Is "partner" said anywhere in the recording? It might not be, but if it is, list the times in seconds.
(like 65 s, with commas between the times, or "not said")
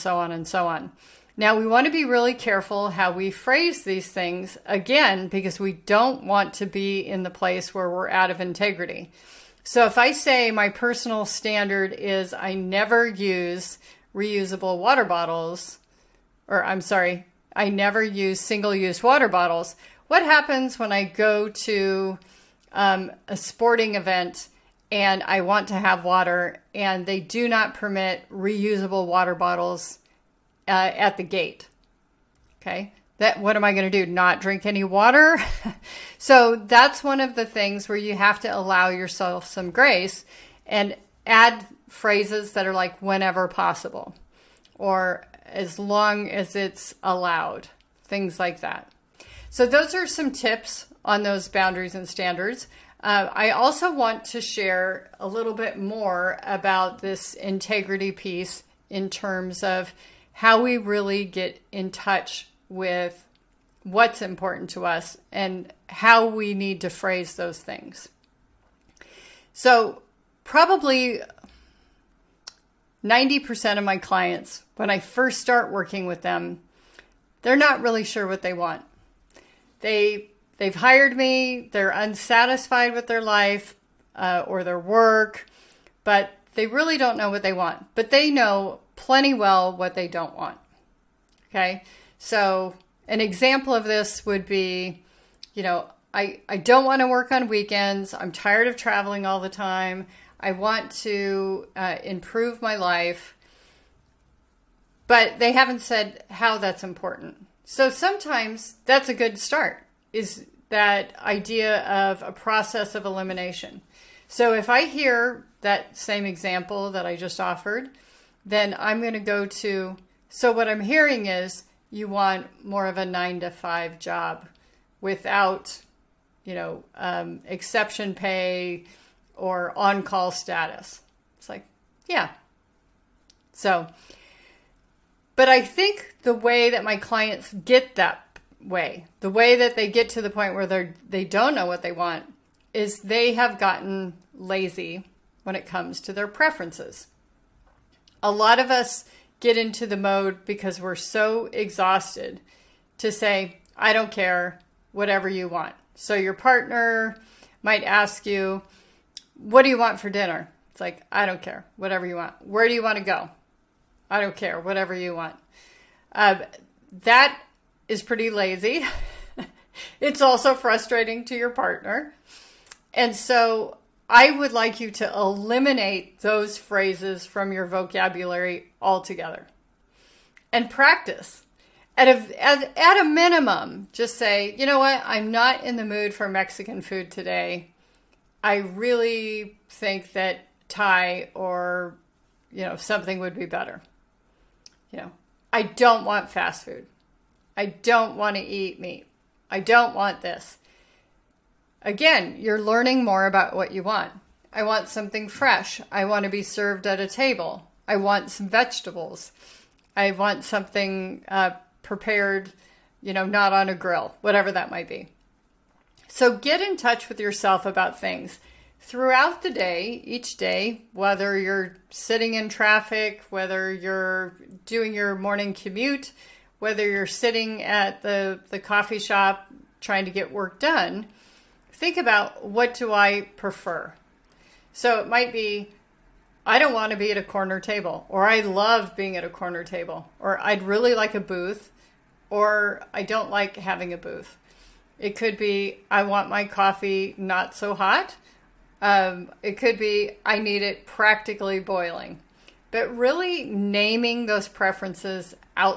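156 s, 171 s.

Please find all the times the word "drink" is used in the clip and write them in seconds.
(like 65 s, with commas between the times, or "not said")
34 s.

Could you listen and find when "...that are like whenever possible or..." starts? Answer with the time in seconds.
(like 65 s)
42 s.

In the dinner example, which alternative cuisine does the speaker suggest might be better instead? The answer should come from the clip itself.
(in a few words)
Thai.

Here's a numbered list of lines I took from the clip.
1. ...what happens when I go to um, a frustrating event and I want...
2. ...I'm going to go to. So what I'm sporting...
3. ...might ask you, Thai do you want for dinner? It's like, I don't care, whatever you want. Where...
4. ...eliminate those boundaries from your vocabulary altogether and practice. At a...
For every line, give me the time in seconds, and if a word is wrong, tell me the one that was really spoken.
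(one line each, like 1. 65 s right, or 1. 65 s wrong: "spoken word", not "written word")
1. 20 s wrong: "sporting", not "frustrating"
2. 118 s wrong: "hearing", not "sporting"
3. 157 s wrong: "What", not "Thai"
4. 175 s wrong: "phrases", not "boundaries".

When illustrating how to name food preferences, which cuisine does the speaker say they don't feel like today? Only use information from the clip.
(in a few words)
Mexican food.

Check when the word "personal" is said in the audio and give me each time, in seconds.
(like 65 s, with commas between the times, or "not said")
10 s.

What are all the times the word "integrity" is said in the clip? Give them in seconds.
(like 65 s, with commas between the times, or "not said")
8 s, 57 s.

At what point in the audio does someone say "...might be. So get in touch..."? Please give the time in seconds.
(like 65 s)
214 s.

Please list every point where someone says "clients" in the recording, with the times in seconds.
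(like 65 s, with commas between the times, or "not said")
73 s, 136 s.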